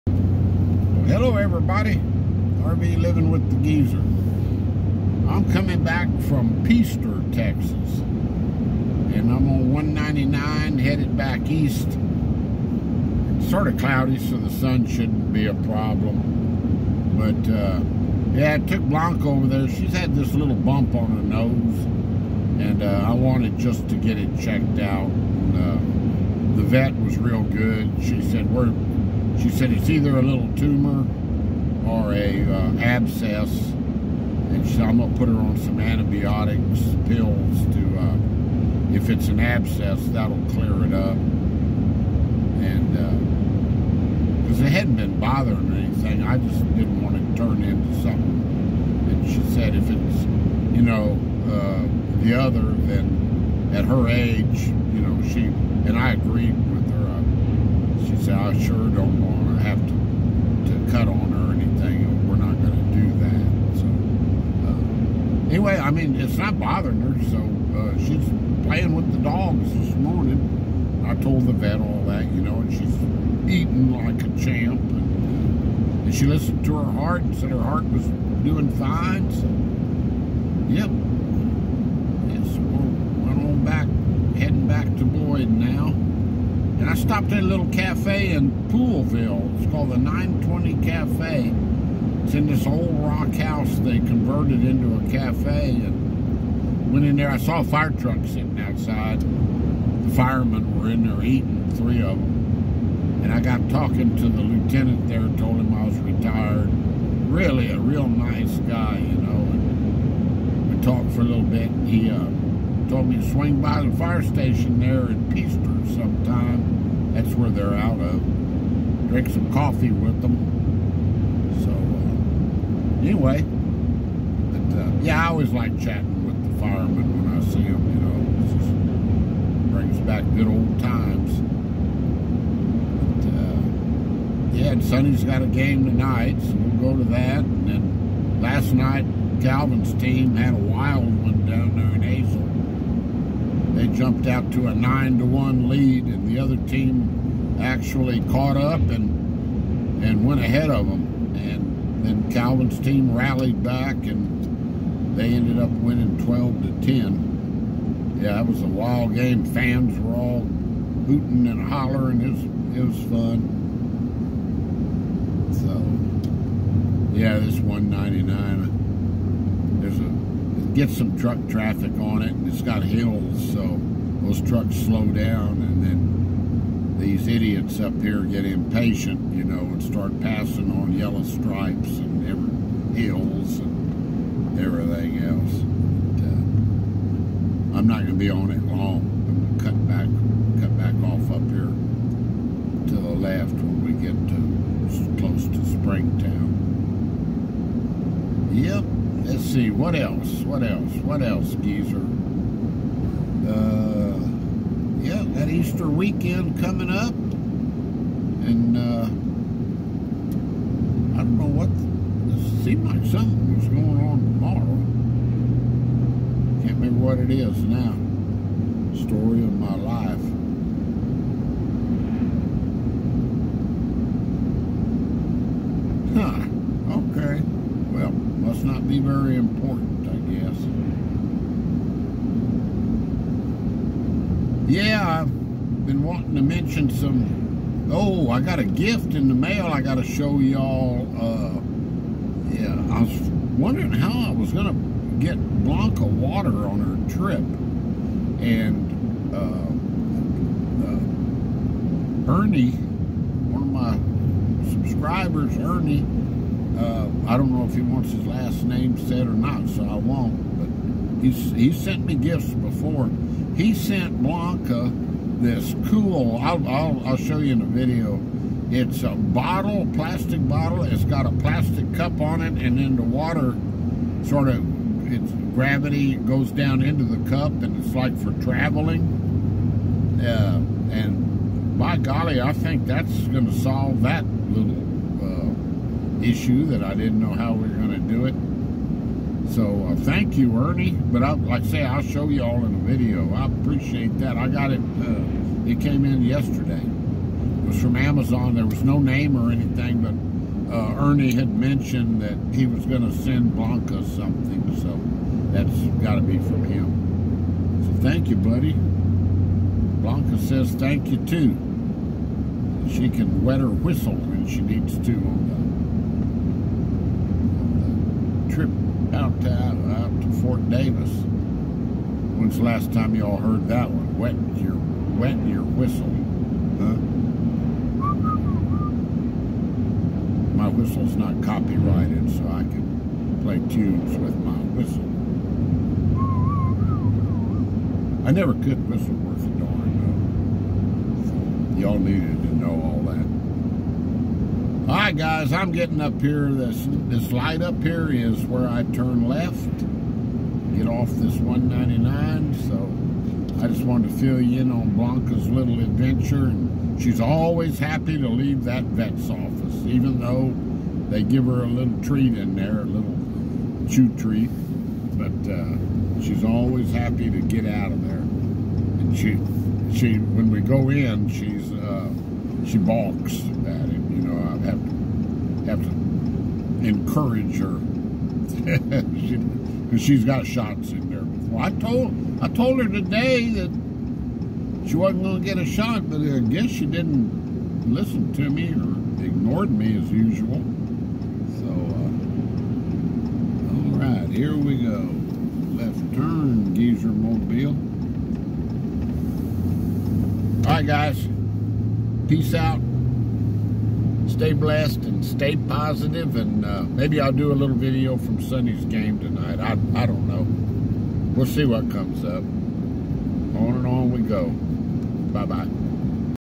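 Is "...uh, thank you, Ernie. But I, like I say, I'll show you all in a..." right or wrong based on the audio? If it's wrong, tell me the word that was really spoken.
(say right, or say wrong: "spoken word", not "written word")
right.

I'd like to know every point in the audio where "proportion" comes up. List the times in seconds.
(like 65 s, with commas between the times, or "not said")
not said.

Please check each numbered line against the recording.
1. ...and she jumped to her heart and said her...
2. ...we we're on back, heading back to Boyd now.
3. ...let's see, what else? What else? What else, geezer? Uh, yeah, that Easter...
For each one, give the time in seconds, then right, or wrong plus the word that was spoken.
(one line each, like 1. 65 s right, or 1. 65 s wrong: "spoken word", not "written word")
1. 76 s wrong: "listened", not "jumped"
2. 82 s right
3. 199 s right.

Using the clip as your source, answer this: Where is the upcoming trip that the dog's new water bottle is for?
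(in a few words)
Fort Davis.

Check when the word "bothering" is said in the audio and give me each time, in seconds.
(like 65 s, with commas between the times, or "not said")
45 s, 66 s.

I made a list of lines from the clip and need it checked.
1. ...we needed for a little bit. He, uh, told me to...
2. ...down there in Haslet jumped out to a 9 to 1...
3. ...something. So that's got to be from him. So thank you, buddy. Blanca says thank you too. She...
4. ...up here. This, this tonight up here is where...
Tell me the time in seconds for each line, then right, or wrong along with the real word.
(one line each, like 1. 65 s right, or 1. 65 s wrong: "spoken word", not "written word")
1. 110 s wrong: "talked", not "needed"
2. 141 s right
3. 304 s right
4. 346 s wrong: "light", not "tonight".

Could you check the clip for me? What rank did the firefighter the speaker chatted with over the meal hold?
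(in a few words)
Lieutenant.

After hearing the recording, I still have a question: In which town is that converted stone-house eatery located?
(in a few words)
Poolville.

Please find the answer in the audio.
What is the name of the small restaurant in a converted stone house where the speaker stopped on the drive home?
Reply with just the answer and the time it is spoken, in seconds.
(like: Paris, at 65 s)
920 Cafe, at 89 s.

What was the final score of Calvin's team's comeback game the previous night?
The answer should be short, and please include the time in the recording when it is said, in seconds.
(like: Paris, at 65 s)
12 to 10, at 156 s.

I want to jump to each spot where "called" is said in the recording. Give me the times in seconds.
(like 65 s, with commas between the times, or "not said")
89 s.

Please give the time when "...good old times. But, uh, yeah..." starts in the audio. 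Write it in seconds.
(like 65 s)
130 s.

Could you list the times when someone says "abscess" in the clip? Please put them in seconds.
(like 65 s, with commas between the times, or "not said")
32 s, 39 s.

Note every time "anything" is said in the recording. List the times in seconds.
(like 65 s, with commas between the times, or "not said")
45 s, 61 s, 299 s.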